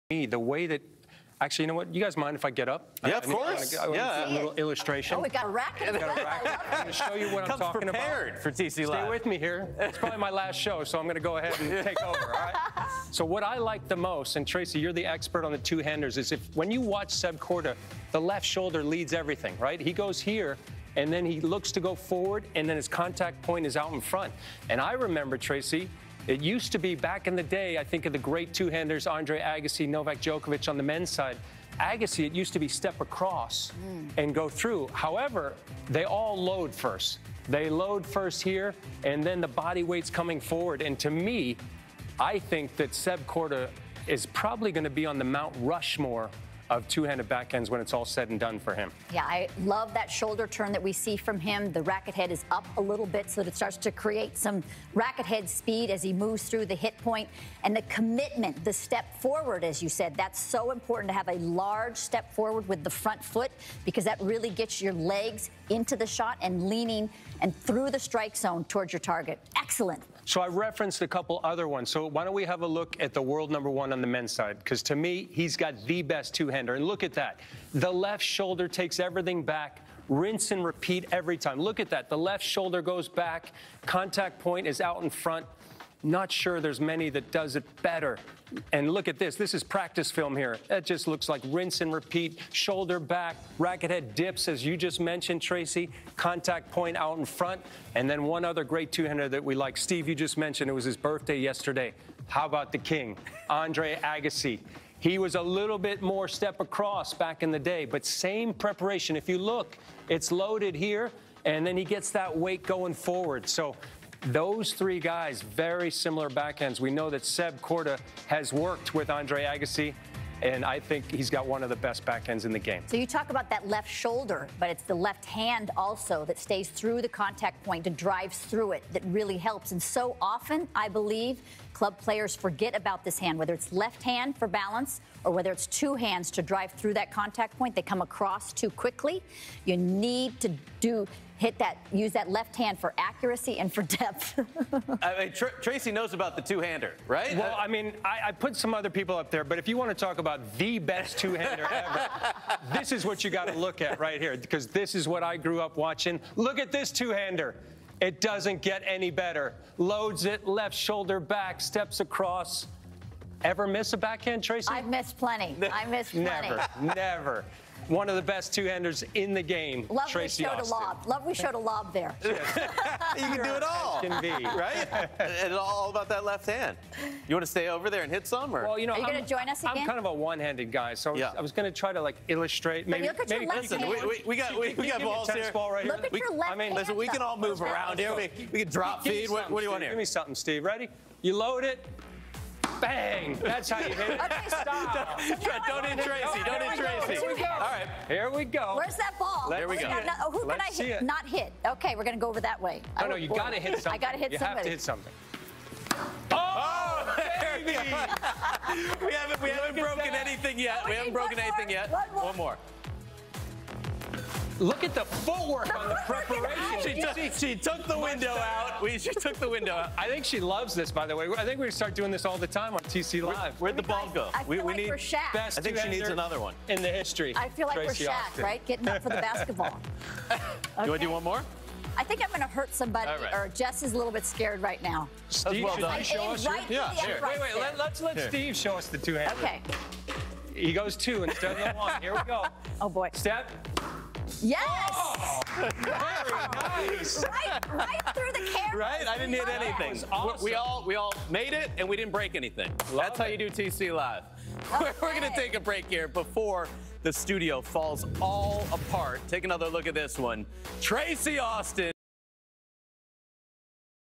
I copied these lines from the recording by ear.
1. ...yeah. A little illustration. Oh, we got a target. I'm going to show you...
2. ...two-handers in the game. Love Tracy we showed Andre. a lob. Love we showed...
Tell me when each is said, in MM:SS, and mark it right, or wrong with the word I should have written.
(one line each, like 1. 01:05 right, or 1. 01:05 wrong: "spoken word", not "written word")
1. 00:03 wrong: "racket", not "target"
2. 02:48 wrong: "Austin", not "Andre".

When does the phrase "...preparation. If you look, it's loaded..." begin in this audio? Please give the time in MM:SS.
01:48.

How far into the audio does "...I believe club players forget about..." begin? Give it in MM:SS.
02:10.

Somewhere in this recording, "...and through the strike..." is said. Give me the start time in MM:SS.
01:07.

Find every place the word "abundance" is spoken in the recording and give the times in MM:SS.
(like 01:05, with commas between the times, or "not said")
not said.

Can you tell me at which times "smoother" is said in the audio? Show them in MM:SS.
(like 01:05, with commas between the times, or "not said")
not said.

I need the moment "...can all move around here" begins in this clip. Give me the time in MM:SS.
03:07.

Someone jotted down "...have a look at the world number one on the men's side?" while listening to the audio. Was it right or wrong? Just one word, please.
right.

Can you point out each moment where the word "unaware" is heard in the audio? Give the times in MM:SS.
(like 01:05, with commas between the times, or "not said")
not said.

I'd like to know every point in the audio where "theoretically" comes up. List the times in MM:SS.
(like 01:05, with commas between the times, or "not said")
not said.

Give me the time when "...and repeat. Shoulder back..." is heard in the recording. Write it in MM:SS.
01:31.